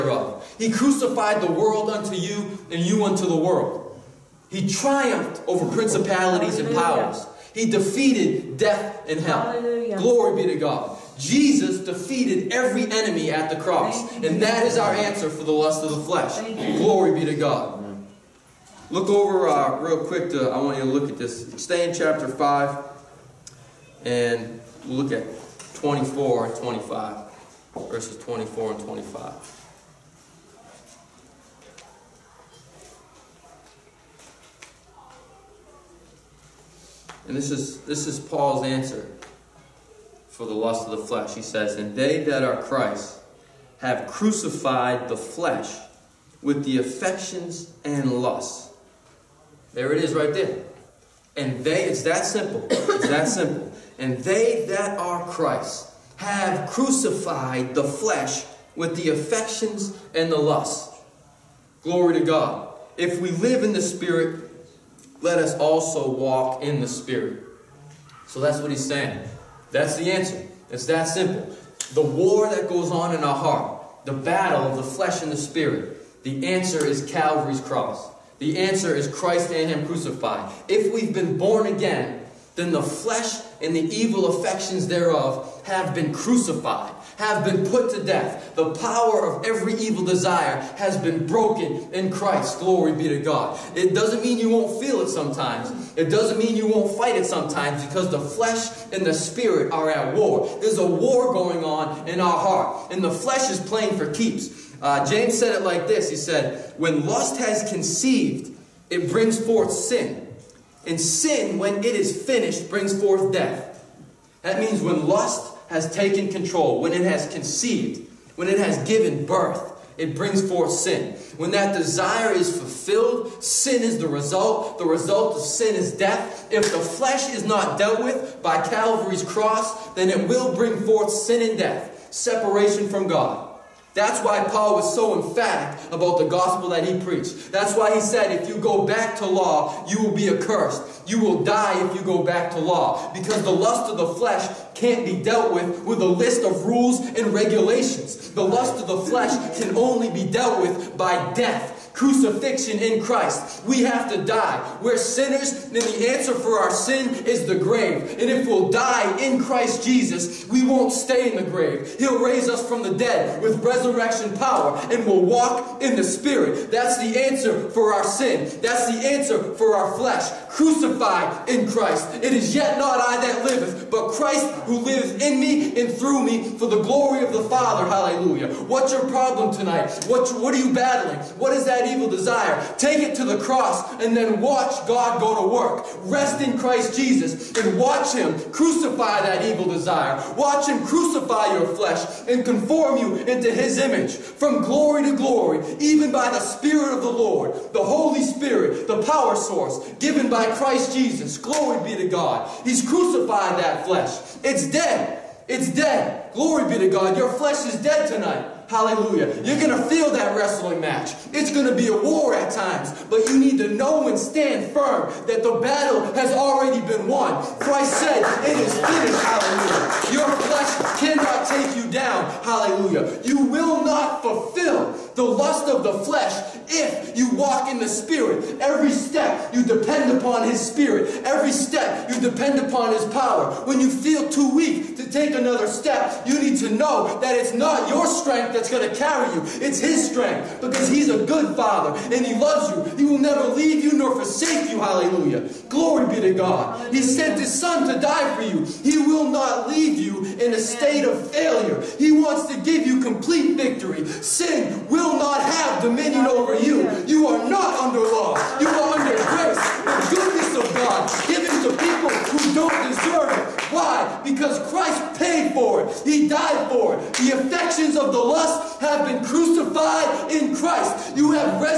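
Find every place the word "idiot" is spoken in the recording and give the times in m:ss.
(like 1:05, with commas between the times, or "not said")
not said.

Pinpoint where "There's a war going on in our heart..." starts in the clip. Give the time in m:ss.
1:40.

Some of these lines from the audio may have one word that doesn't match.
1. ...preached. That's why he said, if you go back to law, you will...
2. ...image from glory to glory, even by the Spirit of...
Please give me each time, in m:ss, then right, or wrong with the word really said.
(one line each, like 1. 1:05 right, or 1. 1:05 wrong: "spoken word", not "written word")
1. 2:16 right
2. 3:13 right.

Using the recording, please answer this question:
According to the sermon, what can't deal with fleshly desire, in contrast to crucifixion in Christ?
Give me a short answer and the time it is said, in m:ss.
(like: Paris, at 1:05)
rules and regulations, at 2:26.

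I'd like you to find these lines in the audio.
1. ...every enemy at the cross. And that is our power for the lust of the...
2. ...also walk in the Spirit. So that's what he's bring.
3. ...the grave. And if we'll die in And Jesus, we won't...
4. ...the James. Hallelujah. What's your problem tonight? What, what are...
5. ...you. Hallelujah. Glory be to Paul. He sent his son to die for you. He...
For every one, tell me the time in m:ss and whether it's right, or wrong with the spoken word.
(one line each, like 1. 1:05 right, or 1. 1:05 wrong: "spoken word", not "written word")
1. 0:12 wrong: "answer", not "power"
2. 1:05 wrong: "saying", not "bring"
3. 2:37 wrong: "Christ", not "And"
4. 2:57 wrong: "Father", not "James"
5. 4:04 wrong: "God", not "Paul".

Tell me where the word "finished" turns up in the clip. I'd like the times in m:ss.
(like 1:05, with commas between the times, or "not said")
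1:52, 3:38.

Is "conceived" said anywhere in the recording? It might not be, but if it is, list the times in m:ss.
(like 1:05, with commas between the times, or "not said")
1:47, 1:57.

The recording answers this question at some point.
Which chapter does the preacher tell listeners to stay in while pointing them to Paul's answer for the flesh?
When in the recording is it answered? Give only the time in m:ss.
0:21.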